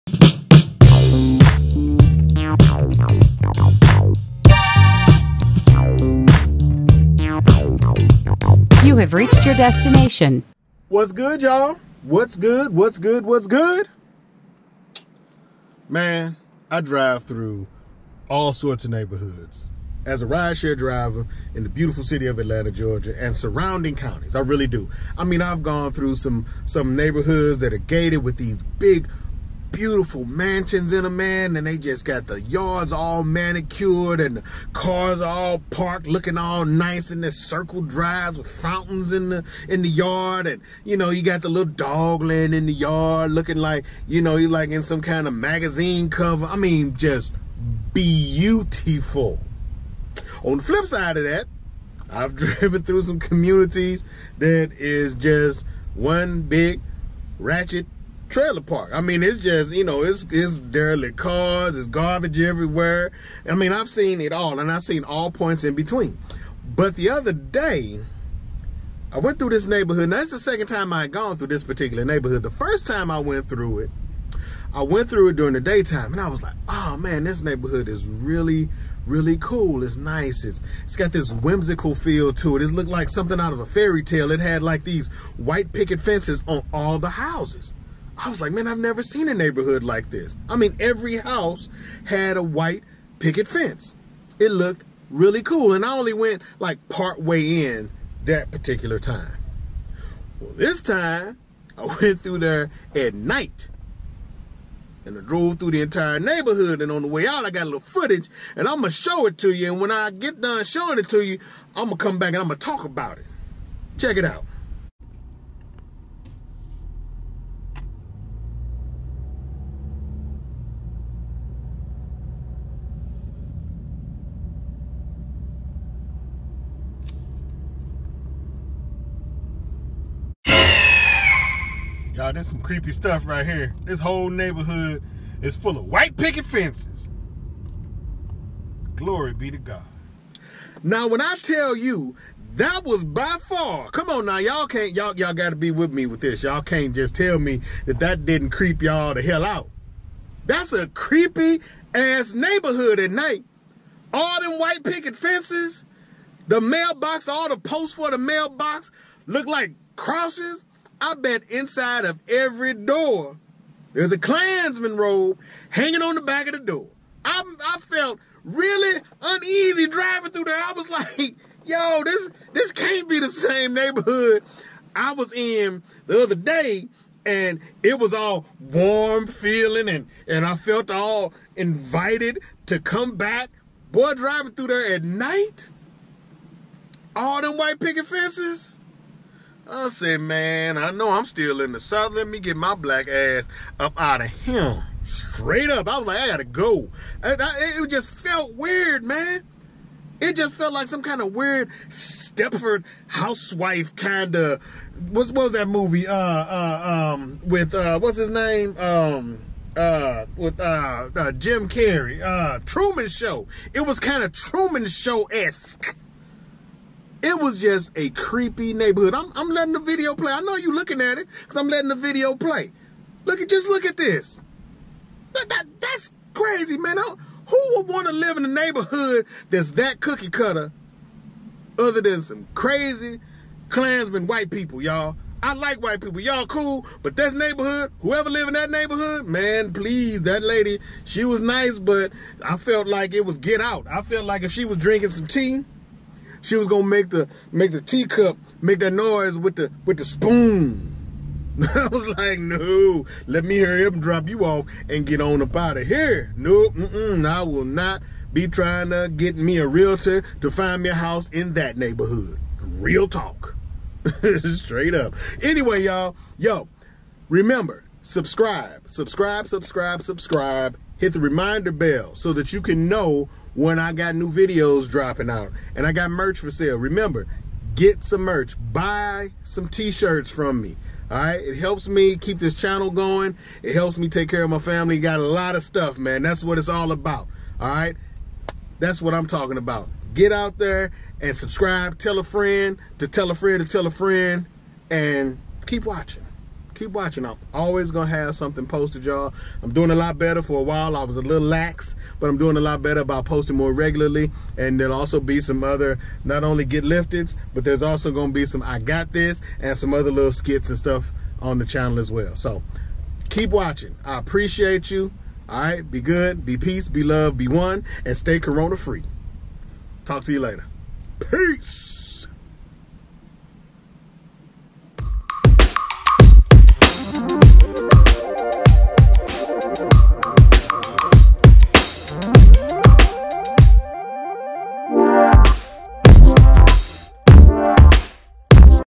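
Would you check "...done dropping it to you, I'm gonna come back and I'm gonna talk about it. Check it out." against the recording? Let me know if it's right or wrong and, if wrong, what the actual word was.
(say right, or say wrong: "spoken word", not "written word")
wrong: "showing", not "dropping".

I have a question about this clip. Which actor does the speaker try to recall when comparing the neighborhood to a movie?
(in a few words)
Jim Carrey.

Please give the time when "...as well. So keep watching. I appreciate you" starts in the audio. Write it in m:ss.
5:11.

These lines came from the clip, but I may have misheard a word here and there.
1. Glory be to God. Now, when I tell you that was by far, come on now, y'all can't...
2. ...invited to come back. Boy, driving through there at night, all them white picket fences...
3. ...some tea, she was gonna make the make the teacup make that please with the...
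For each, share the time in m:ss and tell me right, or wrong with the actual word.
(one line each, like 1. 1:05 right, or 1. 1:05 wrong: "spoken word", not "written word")
1. 2:18 right
2. 3:01 right
3. 4:05 wrong: "noise", not "please".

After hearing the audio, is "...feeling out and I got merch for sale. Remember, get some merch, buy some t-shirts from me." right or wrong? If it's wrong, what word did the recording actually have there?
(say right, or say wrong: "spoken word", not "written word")
wrong: "dropping", not "feeling".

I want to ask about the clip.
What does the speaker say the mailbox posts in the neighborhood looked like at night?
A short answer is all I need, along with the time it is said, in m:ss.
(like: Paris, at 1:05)
Crosses, at 2:39.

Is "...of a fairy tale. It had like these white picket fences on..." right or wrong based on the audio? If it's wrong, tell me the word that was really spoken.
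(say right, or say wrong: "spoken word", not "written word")
right.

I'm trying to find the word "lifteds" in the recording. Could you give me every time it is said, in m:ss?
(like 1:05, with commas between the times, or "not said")
5:06.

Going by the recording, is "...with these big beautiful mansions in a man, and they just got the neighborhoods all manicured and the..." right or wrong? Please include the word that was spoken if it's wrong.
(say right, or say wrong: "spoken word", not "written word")
wrong: "yards", not "neighborhoods".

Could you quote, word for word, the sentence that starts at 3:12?
Let me get my black ass up out of here.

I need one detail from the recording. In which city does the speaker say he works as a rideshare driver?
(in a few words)
Atlanta.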